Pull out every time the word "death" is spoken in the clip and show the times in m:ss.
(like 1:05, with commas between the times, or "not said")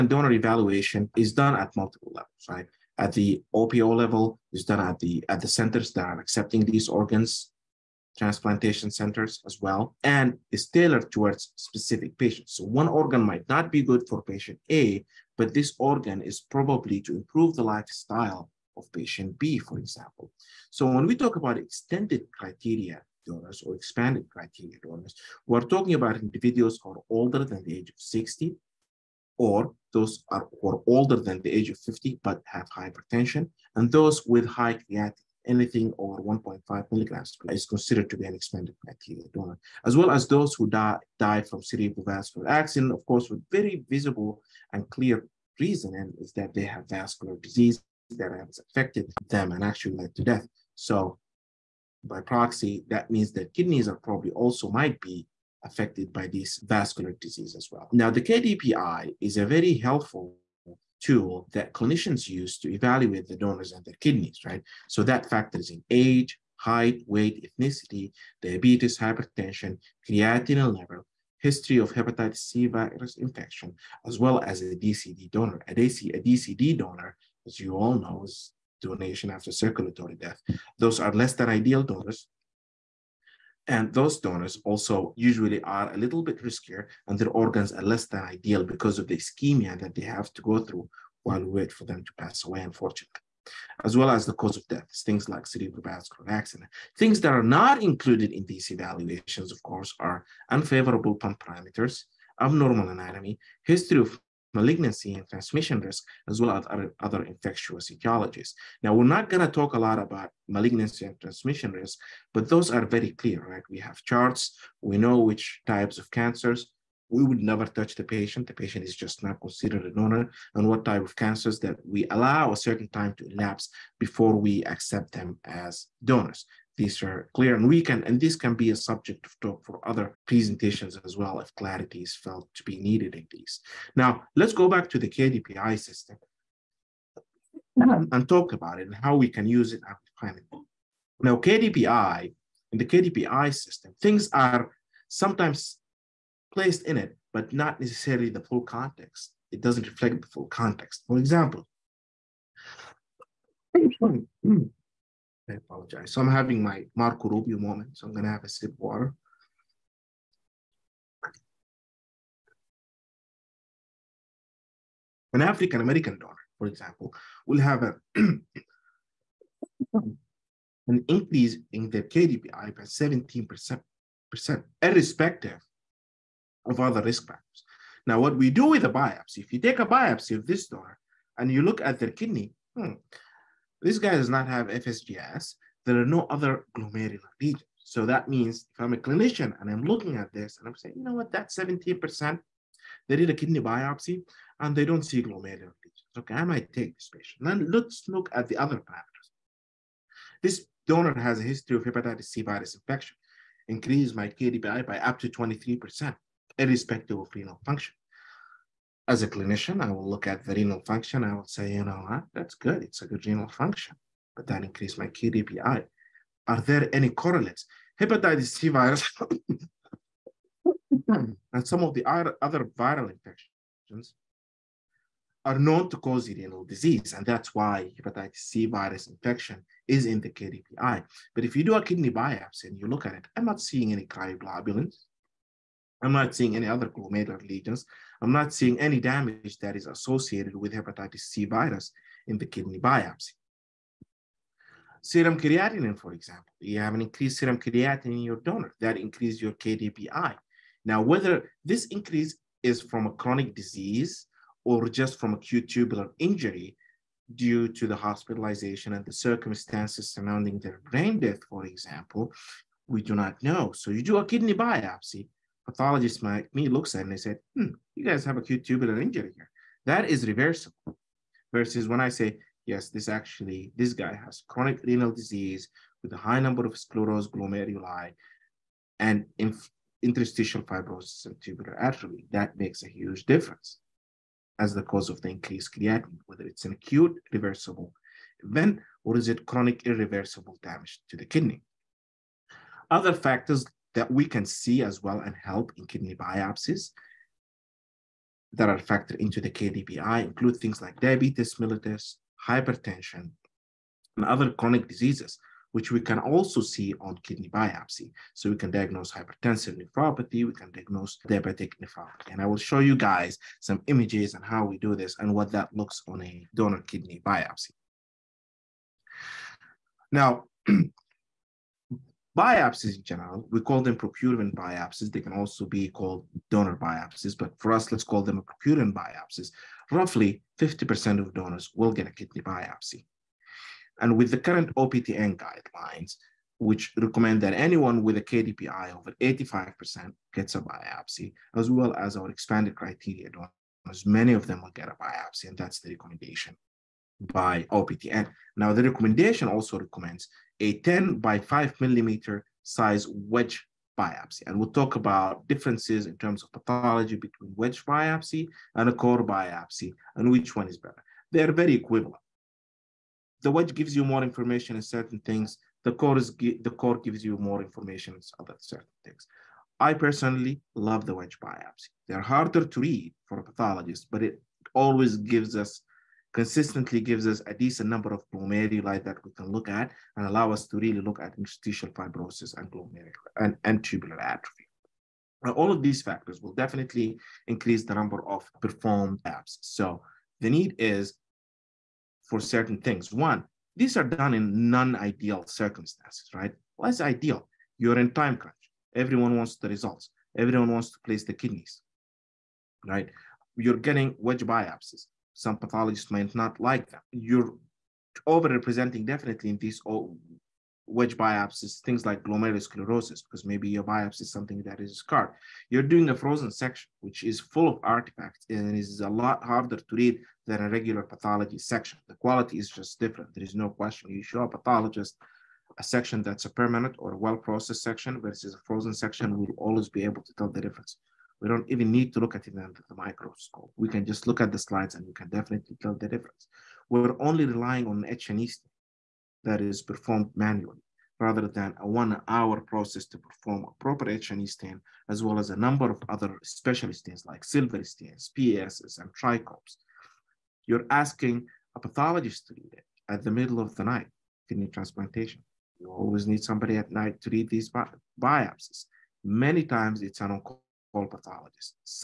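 0:50, 1:20, 1:34, 4:21.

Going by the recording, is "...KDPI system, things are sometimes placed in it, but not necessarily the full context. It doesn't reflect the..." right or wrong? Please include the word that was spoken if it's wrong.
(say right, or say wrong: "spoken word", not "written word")
right.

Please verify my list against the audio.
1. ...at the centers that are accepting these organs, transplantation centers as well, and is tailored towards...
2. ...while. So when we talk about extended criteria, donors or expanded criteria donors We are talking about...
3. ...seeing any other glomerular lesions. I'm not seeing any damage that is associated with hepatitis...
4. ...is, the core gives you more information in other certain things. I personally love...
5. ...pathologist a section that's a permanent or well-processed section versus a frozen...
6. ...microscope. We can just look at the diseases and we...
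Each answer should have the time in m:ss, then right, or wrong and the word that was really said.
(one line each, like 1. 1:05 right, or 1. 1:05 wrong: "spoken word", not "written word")
1. 0:05 right
2. 0:19 wrong: "example", not "while"
3. 3:56 right
4. 6:06 right
5. 7:04 right
6. 7:12 wrong: "slides", not "diseases".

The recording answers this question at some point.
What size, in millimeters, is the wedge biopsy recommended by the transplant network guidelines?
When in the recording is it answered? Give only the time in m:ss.
5:50.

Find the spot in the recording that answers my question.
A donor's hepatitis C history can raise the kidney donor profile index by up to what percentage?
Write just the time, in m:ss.
3:25.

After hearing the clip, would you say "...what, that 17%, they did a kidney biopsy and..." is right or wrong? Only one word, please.
right.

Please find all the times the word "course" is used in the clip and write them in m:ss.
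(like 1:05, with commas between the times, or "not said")
0:43, 1:39.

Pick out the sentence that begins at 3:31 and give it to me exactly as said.
I will say, you know what, that's good.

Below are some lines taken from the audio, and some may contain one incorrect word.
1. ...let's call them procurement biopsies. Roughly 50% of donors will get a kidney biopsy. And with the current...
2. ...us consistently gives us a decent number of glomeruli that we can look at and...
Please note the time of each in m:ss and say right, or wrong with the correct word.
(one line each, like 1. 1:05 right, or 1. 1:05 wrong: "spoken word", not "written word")
1. 5:27 right
2. 6:15 right.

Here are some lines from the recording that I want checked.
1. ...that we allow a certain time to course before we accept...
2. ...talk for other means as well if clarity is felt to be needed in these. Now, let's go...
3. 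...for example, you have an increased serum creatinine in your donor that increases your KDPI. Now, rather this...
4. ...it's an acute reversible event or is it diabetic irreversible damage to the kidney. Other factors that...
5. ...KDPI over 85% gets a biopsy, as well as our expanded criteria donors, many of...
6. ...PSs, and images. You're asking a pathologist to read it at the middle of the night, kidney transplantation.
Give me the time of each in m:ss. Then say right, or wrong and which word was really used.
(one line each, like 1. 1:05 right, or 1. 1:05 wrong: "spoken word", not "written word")
1. 2:01 wrong: "elapse", not "course"
2. 2:09 wrong: "presentations", not "means"
3. 4:05 wrong: "whether", not "rather"
4. 4:46 wrong: "chronic", not "diabetic"
5. 5:38 right
6. 7:28 wrong: "trichromes", not "images".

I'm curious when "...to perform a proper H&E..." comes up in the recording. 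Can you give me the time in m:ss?
7:23.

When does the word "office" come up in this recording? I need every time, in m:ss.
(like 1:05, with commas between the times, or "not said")
not said.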